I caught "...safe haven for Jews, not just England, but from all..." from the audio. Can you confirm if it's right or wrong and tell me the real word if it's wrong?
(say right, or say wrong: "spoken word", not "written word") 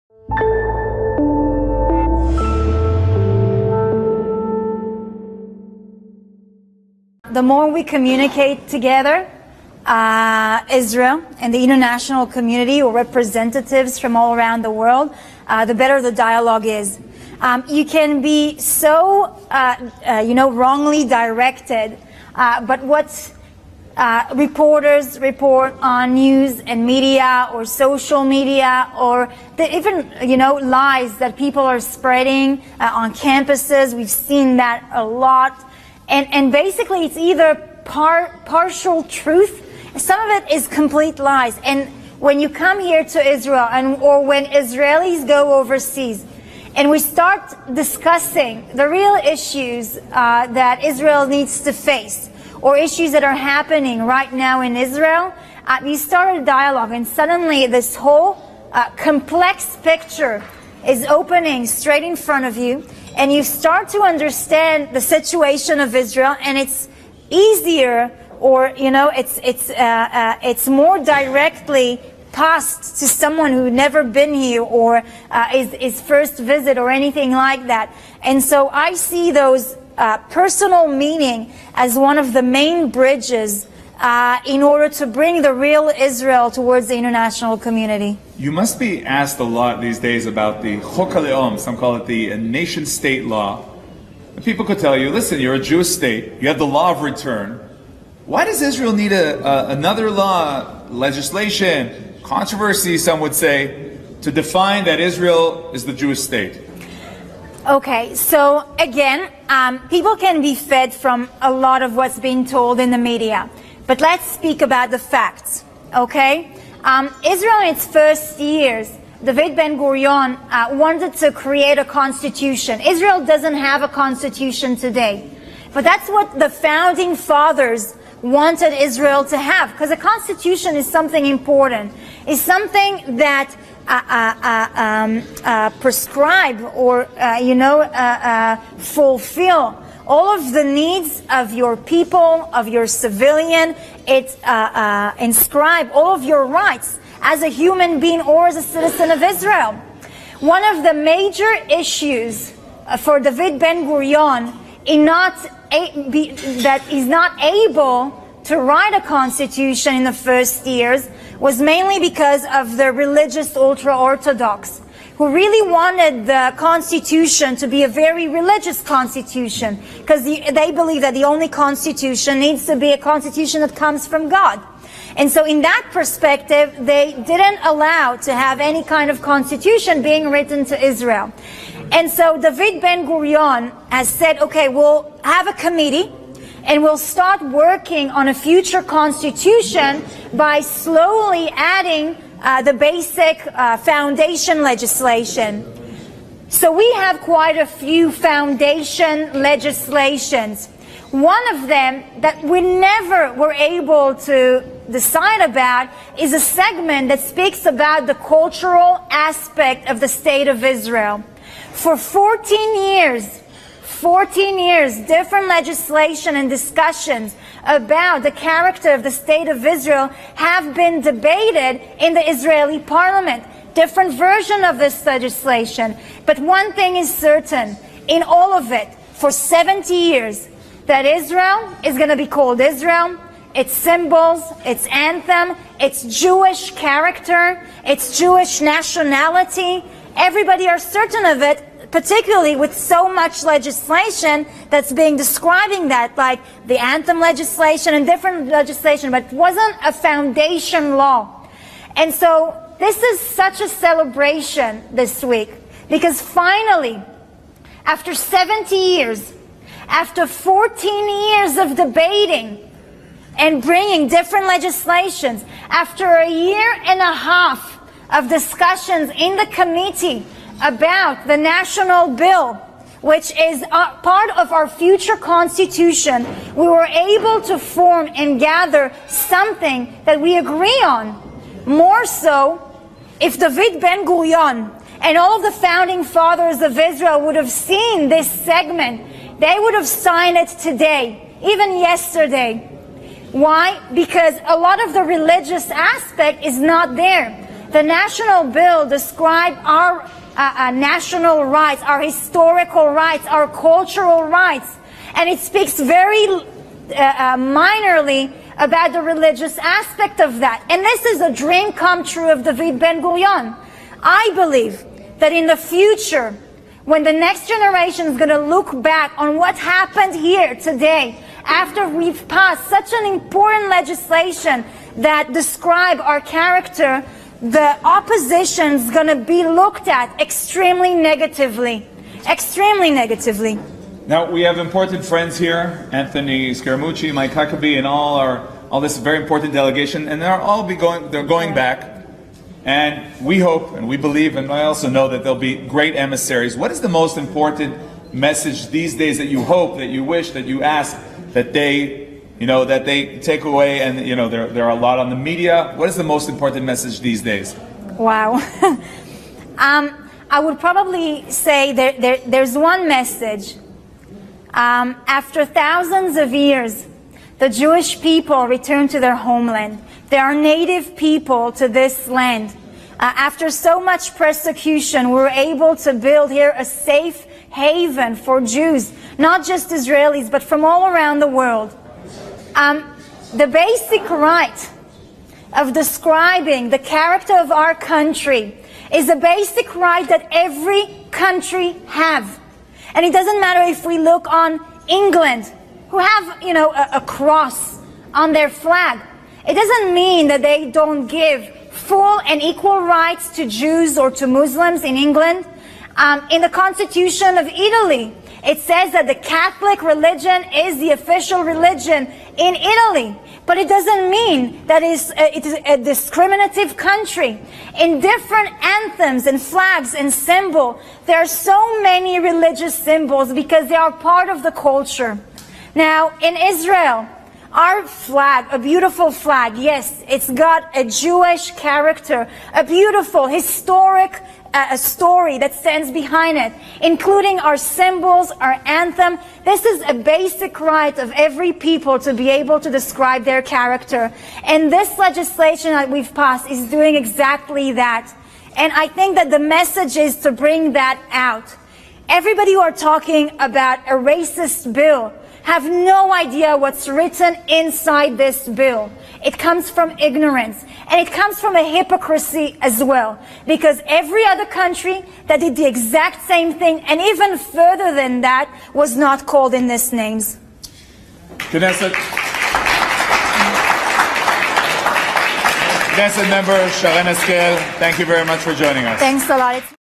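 wrong: "Israelis", not "England".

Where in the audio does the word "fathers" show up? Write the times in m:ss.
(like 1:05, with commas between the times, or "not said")
2:07, 4:46.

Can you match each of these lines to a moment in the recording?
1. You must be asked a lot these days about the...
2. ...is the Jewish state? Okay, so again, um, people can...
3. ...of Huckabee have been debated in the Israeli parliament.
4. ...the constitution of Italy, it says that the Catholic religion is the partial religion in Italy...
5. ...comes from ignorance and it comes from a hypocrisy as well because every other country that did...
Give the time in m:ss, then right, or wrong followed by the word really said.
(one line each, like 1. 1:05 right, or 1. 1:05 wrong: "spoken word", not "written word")
1. 1:28 right
2. 1:45 right
3. 3:39 wrong: "Israel", not "Huckabee"
4. 6:46 wrong: "official", not "partial"
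5. 7:39 right.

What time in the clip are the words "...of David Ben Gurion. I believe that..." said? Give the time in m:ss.
5:12.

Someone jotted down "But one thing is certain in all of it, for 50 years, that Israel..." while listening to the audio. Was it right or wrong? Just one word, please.
wrong.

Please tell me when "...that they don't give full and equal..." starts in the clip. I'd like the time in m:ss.
6:40.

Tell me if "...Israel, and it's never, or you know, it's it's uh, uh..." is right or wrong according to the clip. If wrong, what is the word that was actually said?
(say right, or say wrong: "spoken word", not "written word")
wrong: "easier", not "never".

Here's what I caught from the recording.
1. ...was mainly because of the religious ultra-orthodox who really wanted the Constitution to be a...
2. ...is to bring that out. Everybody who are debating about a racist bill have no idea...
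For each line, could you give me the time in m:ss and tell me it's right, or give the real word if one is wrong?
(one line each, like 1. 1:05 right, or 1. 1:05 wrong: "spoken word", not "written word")
1. 2:41 right
2. 7:29 wrong: "talking", not "debating".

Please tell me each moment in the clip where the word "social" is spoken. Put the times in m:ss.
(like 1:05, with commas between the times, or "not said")
0:27.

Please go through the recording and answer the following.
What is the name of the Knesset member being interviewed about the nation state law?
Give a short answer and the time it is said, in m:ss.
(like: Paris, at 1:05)
Sharen Haskel, at 7:56.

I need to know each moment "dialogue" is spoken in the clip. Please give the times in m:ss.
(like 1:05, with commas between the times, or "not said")
0:16, 0:56.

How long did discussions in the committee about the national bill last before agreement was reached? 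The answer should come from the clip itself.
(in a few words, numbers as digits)
a year and a half.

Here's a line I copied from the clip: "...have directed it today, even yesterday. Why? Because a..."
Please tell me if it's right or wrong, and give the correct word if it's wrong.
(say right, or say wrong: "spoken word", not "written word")
wrong: "signed", not "directed".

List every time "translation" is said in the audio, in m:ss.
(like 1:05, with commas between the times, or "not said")
not said.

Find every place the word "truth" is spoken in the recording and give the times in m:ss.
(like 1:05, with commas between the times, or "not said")
0:39.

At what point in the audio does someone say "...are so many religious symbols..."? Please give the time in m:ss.
7:01.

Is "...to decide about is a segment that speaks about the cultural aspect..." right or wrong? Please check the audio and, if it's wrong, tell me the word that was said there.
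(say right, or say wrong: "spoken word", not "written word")
right.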